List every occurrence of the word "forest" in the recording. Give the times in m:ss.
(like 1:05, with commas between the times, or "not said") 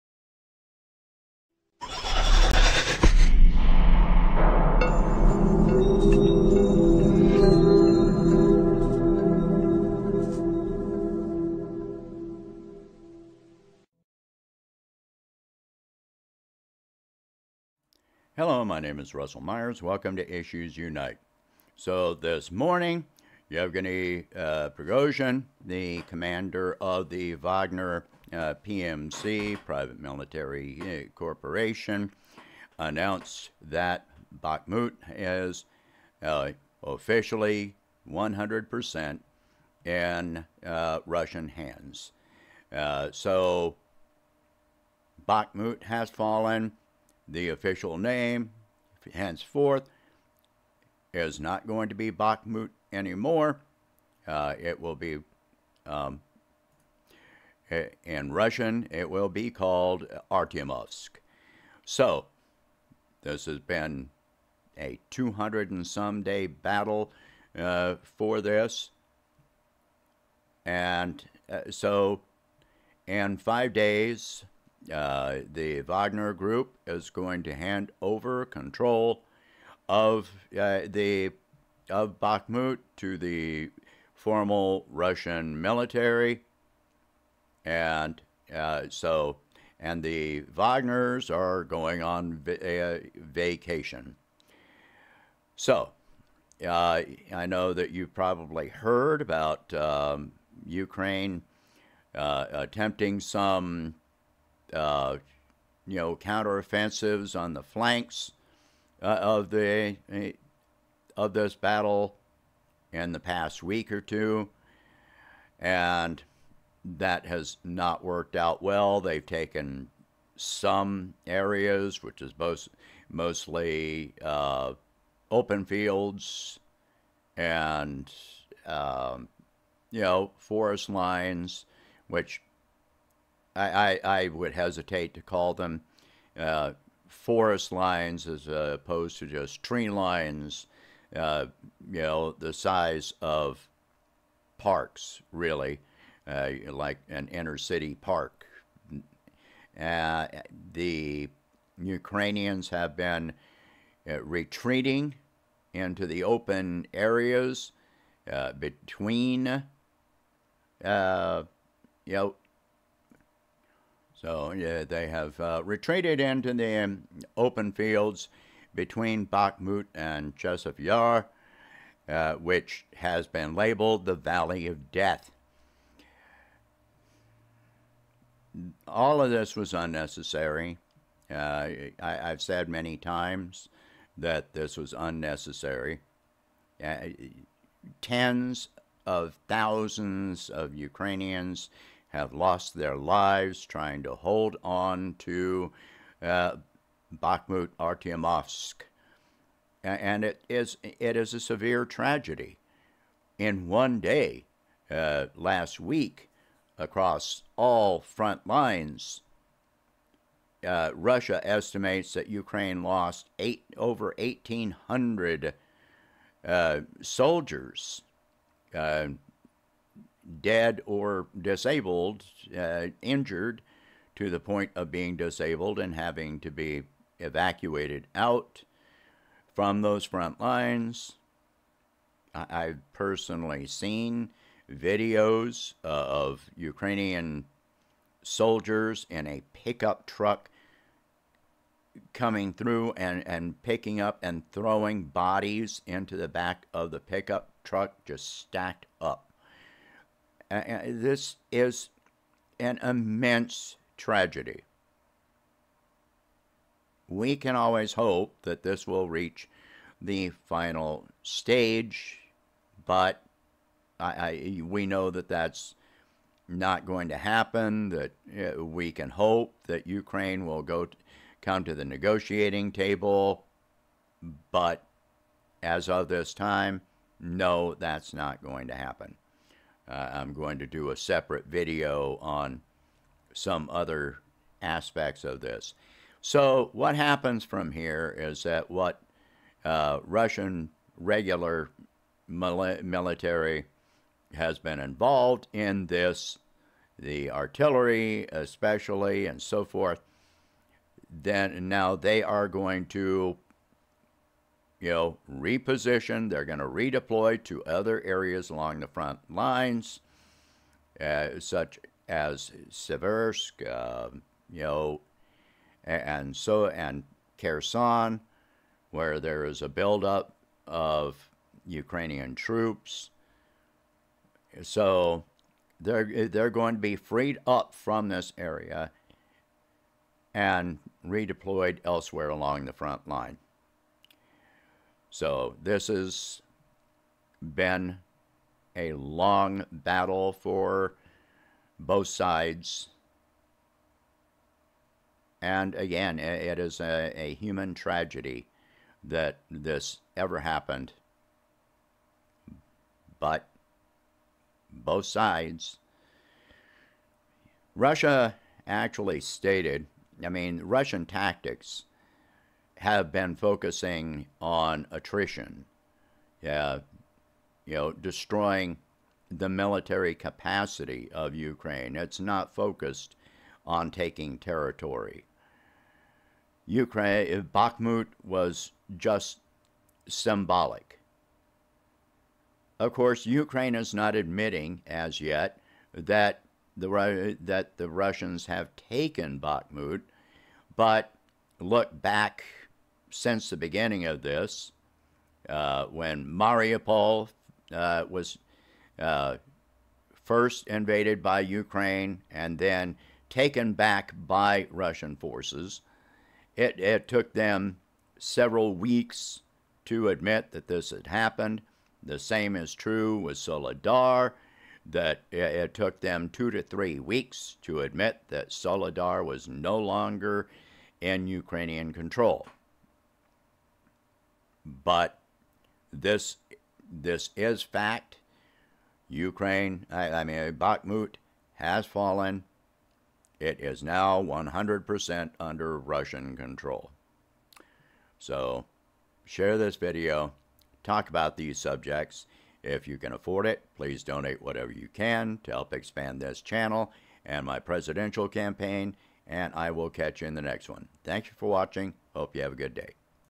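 2:10, 2:17.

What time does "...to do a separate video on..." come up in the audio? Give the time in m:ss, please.
4:40.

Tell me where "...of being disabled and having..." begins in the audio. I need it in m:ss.
3:44.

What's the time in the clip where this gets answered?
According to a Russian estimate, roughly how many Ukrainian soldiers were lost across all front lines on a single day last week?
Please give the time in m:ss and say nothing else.
3:33.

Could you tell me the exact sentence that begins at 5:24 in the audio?
So they're they're going to be freed up from this area and redeployed elsewhere along the front line.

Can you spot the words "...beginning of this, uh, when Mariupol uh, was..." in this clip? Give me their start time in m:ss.
6:33.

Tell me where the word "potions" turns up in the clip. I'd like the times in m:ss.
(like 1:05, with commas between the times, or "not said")
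not said.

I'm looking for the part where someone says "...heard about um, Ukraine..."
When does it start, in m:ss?
1:38.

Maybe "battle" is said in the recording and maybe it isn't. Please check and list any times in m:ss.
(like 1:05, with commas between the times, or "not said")
1:06, 1:51, 5:39.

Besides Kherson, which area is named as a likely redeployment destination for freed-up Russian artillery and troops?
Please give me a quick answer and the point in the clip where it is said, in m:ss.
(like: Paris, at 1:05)
Seversk, at 5:12.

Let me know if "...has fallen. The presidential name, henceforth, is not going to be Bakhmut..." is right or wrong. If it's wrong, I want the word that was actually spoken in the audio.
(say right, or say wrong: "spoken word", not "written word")
wrong: "official", not "presidential".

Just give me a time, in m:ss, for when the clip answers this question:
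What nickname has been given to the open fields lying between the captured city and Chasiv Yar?
2:54.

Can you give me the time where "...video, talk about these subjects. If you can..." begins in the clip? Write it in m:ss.
7:19.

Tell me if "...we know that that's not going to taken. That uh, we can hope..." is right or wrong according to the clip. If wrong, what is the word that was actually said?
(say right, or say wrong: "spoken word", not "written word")
wrong: "happen", not "taken".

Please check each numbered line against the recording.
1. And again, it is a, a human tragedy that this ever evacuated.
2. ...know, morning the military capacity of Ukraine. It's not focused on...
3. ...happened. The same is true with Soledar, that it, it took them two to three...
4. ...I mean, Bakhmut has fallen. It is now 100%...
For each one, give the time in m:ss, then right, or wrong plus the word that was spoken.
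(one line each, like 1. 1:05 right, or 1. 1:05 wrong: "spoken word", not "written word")
1. 5:45 wrong: "happened", not "evacuated"
2. 6:07 wrong: "destroying", not "morning"
3. 6:51 right
4. 7:10 right.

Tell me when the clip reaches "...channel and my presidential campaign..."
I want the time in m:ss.
7:26.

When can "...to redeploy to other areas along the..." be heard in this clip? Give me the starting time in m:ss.
5:06.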